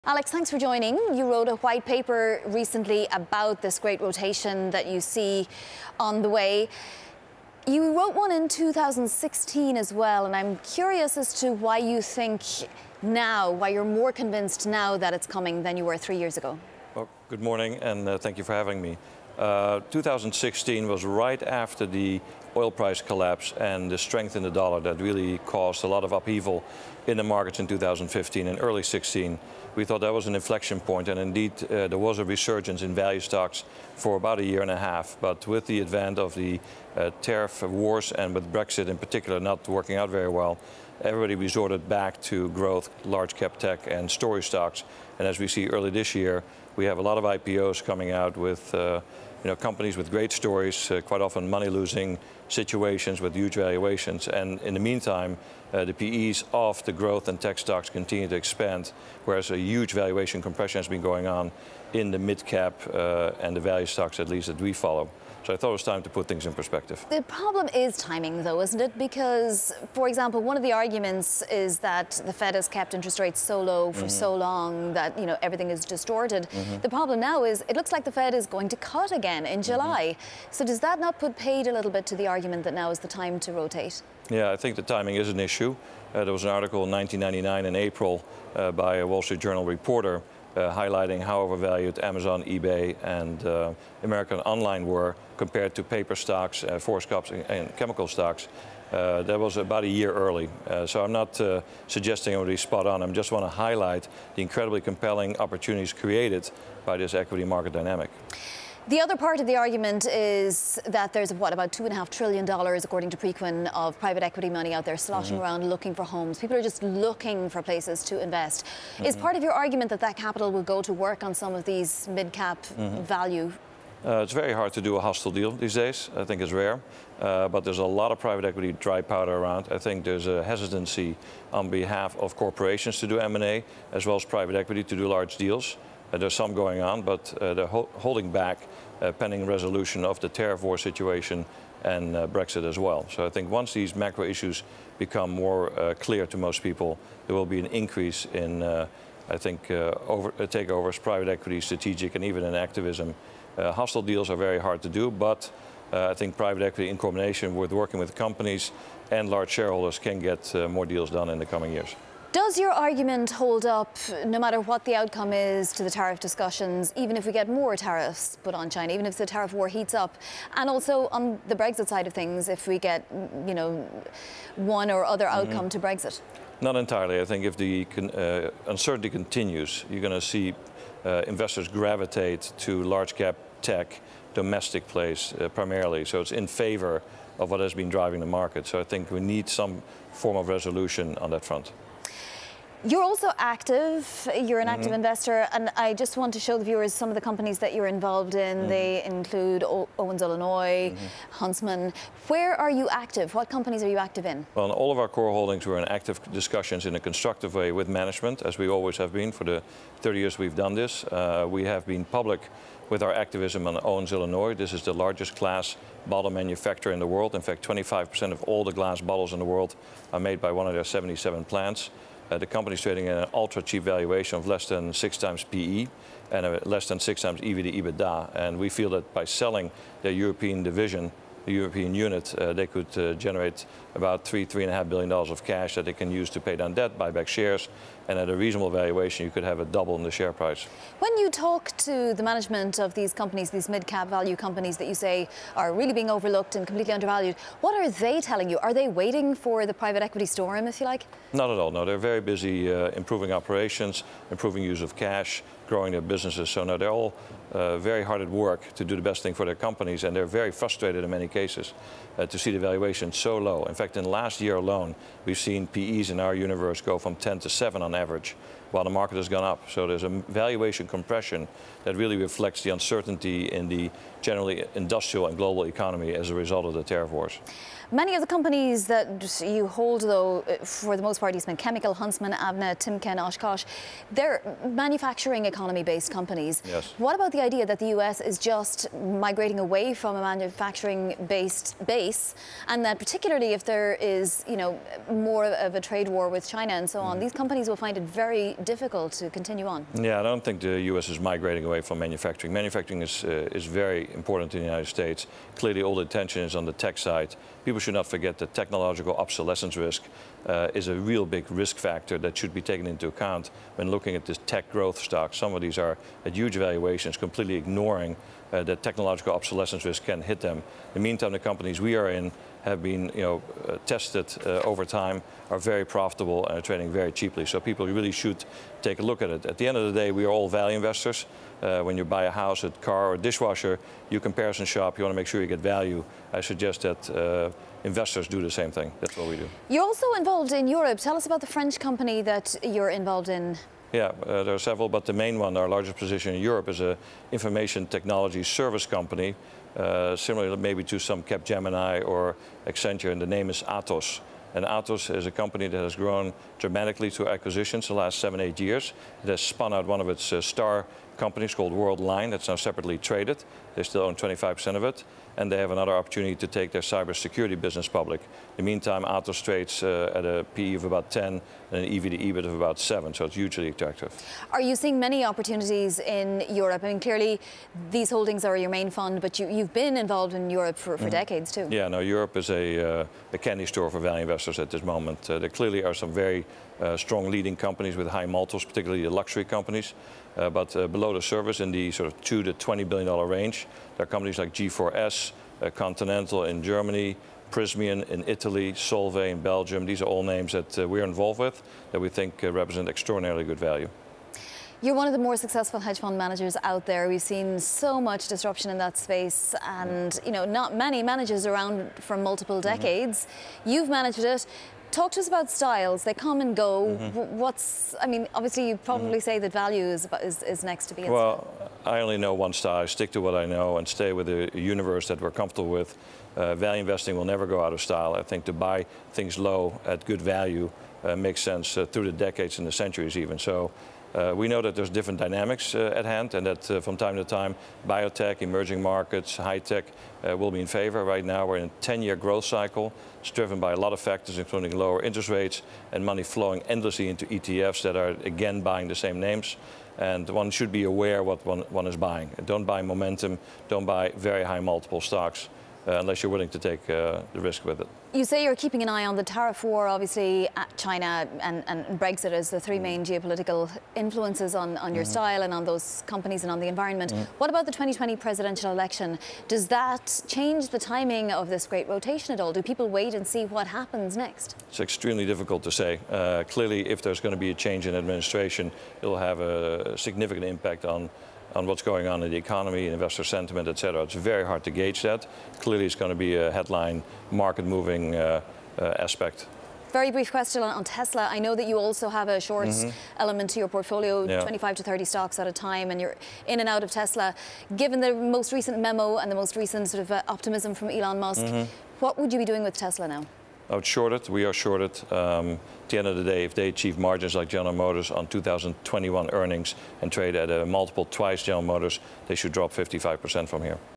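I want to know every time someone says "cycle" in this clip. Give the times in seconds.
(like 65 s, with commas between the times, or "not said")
442 s.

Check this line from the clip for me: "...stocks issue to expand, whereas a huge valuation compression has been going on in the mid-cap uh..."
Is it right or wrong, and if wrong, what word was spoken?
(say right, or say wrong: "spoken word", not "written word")
wrong: "continue", not "issue".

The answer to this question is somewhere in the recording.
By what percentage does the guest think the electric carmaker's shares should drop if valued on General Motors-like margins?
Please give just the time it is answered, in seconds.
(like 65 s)
512 s.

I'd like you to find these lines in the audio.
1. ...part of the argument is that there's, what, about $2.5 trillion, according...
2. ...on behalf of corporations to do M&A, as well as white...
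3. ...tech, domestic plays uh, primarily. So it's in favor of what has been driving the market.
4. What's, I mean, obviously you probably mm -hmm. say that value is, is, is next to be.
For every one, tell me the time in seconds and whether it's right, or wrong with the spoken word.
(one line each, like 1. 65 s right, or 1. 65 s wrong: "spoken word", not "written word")
1. 109 s right
2. 131 s wrong: "private", not "white"
3. 183 s right
4. 417 s right.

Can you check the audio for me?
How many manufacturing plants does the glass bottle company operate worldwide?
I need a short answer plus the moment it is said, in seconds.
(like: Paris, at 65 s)
77, at 220 s.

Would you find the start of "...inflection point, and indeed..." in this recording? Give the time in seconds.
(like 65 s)
30 s.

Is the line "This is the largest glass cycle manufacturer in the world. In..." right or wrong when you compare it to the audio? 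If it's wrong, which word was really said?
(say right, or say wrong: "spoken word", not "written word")
wrong: "bottle", not "cycle".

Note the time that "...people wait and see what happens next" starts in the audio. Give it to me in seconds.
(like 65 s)
472 s.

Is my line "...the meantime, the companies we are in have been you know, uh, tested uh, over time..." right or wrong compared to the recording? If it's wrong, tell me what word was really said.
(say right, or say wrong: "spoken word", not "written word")
right.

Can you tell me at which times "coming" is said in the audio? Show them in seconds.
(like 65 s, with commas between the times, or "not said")
15 s, 47 s, 161 s.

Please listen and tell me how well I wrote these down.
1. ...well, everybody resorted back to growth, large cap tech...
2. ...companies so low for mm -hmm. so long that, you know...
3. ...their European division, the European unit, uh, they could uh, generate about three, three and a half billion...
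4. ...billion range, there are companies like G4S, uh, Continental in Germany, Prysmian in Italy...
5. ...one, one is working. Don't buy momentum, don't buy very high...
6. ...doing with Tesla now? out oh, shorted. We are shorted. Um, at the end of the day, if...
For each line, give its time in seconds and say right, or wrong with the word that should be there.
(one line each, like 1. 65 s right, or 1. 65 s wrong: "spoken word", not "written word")
1. 40 s right
2. 73 s wrong: "rates", not "companies"
3. 230 s right
4. 392 s right
5. 451 s wrong: "buying", not "working"
6. 502 s right.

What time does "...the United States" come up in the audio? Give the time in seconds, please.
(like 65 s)
304 s.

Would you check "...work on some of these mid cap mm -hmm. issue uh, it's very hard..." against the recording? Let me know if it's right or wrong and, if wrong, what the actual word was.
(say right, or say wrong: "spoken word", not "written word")
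wrong: "value", not "issue".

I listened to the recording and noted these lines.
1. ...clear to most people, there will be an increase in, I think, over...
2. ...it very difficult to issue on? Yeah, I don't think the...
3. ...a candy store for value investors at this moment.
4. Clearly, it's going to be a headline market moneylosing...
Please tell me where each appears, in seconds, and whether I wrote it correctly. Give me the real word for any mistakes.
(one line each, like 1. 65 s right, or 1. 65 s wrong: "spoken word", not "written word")
1. 145 s right
2. 297 s wrong: "continue", not "issue"
3. 383 s right
4. 485 s wrong: "moving", not "moneylosing".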